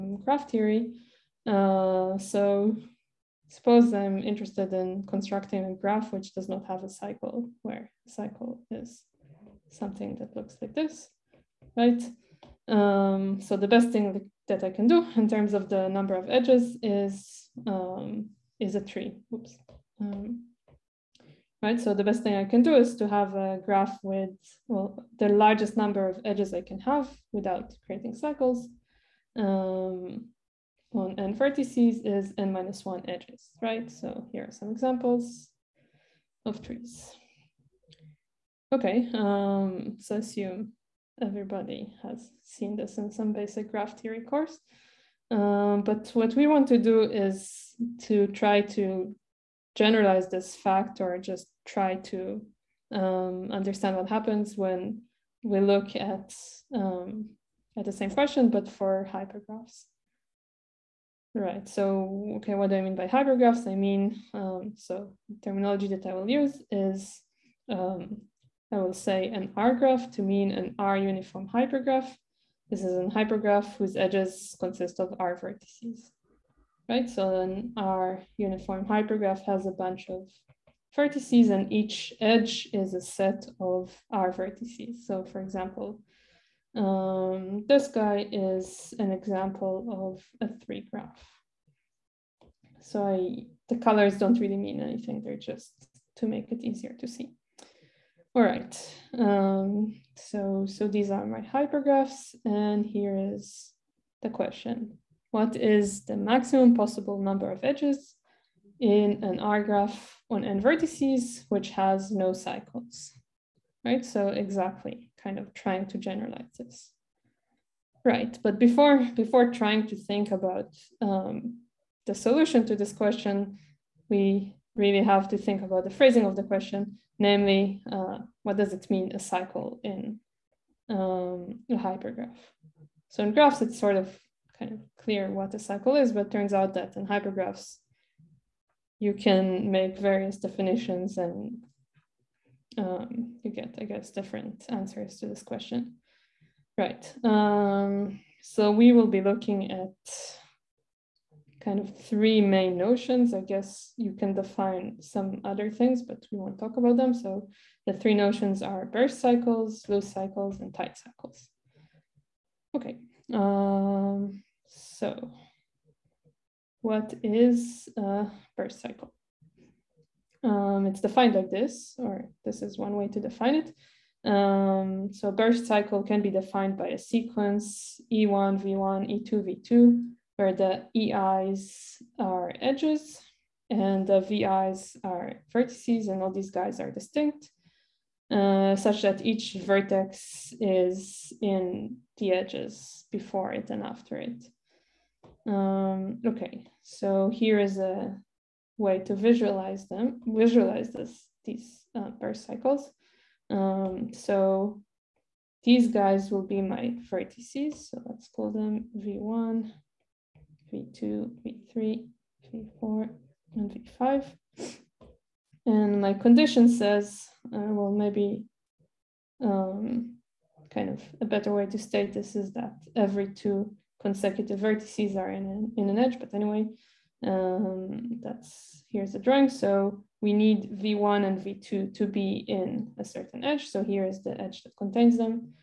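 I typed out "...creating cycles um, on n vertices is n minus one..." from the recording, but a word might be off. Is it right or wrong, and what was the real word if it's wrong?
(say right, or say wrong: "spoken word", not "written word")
right.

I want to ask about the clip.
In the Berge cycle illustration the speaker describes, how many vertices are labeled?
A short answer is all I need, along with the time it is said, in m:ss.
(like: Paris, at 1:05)
5, at 3:33.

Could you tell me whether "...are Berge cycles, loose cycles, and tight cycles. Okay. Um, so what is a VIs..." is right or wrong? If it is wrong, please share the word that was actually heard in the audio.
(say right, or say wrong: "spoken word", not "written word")
wrong: "Berge", not "VIs".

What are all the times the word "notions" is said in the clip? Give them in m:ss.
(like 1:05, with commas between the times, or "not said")
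2:32, 2:38.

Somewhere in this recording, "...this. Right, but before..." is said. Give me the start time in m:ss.
1:56.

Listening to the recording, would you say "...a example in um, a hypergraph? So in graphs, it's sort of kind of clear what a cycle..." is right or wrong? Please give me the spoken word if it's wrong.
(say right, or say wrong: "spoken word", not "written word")
wrong: "cycle", not "example".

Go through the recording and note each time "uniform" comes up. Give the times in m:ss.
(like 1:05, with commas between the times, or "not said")
1:10, 1:18.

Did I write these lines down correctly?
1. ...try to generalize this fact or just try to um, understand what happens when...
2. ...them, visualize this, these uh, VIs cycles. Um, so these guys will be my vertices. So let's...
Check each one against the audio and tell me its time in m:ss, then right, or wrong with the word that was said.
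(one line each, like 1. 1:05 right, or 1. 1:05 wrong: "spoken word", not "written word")
1. 0:48 right
2. 3:19 wrong: "Berge", not "VIs".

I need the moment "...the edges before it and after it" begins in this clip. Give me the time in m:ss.
3:12.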